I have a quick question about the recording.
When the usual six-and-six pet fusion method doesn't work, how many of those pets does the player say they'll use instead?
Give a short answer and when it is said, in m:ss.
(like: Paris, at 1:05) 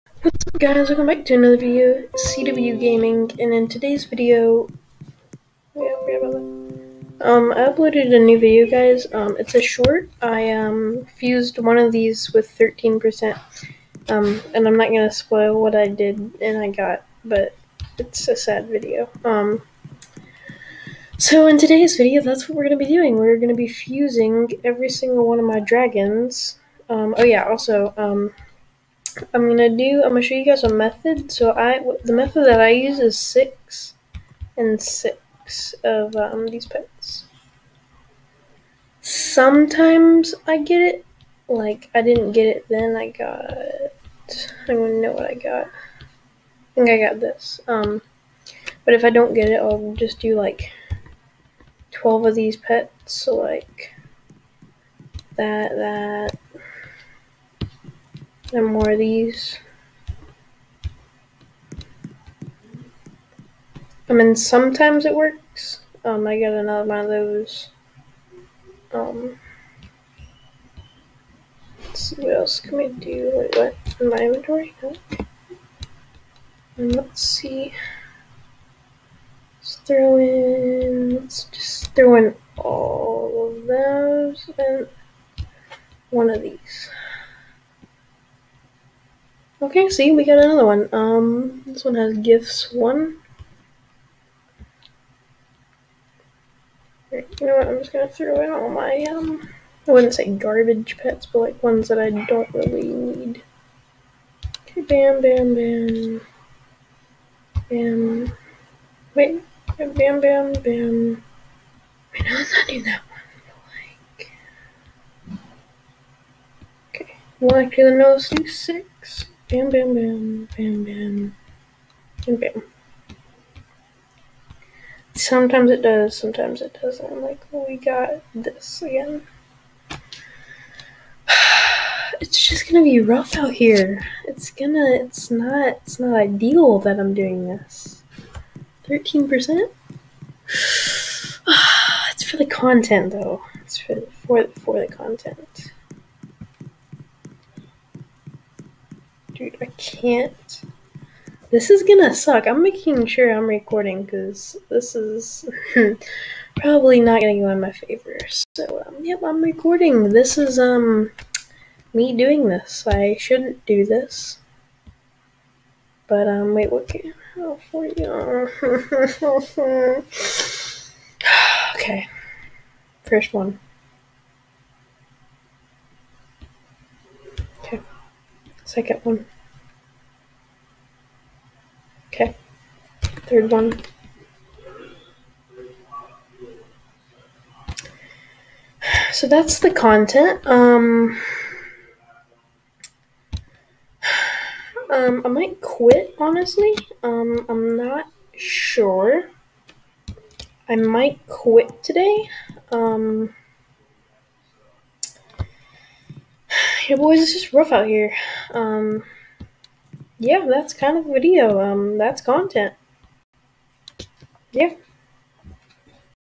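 12, at 0:51.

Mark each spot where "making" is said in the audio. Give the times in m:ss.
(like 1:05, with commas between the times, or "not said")
2:32.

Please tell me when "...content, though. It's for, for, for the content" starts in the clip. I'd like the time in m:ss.
2:22.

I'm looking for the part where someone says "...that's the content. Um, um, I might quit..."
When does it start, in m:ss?
3:09.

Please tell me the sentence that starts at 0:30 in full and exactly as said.
I'm gonna show you guys a method.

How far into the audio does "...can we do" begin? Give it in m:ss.
1:12.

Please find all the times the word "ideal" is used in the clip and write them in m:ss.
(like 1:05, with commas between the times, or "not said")
2:16.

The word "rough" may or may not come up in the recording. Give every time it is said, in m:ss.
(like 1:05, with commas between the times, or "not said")
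2:13, 3:27.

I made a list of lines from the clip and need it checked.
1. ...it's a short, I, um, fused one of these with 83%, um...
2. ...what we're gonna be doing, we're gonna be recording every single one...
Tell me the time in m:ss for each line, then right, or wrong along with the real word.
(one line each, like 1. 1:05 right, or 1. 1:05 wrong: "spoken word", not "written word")
1. 0:09 wrong: "13", not "83"
2. 0:22 wrong: "fusing", not "recording".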